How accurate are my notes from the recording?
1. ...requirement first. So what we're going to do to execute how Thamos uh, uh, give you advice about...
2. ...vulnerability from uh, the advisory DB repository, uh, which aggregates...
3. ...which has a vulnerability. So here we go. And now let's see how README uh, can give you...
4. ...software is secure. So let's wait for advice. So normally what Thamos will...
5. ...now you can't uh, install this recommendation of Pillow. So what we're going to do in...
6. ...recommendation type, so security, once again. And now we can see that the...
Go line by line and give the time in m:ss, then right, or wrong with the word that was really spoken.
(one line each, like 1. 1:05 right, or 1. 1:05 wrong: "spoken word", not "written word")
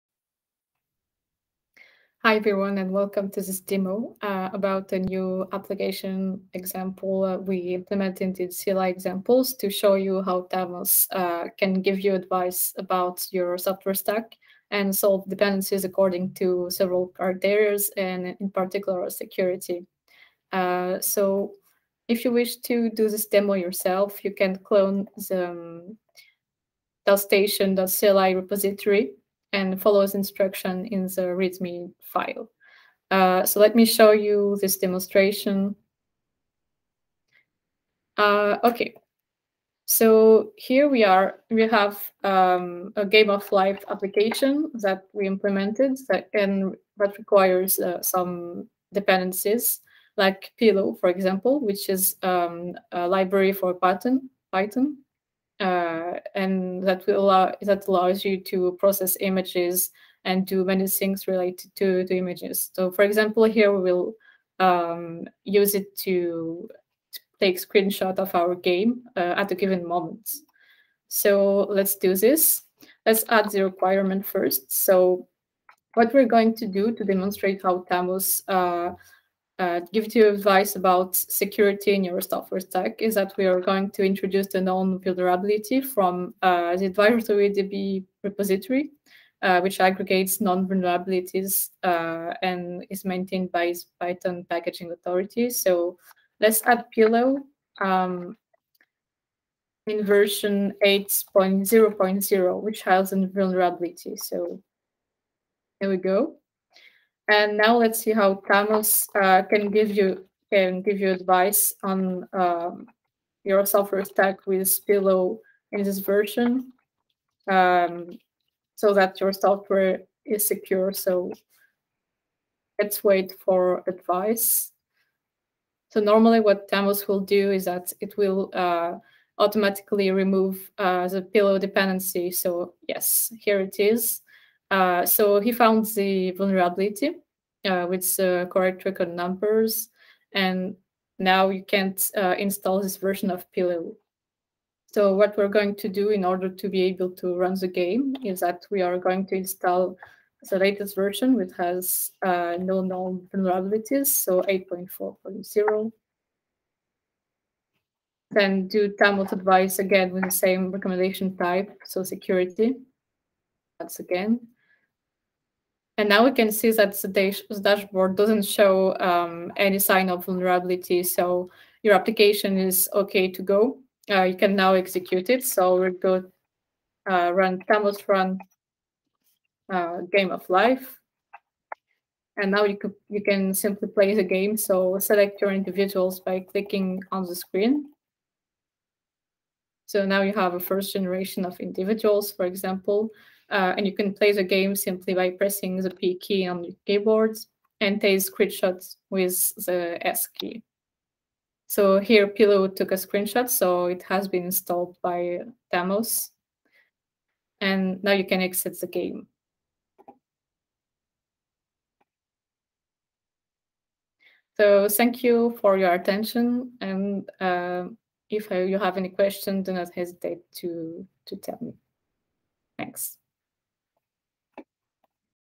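1. 1:13 wrong: "demonstrate", not "execute"
2. 1:24 right
3. 1:42 wrong: "Thamos", not "README"
4. 1:59 right
5. 2:21 wrong: "version", not "recommendation"
6. 2:40 right.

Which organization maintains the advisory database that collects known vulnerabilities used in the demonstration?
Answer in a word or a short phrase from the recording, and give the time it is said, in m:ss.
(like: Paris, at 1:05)
Python packaging authority, at 1:33.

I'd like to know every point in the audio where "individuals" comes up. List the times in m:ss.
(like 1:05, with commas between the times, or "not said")
3:05, 3:11.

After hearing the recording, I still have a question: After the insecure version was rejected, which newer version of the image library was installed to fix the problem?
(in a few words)
8.4.0.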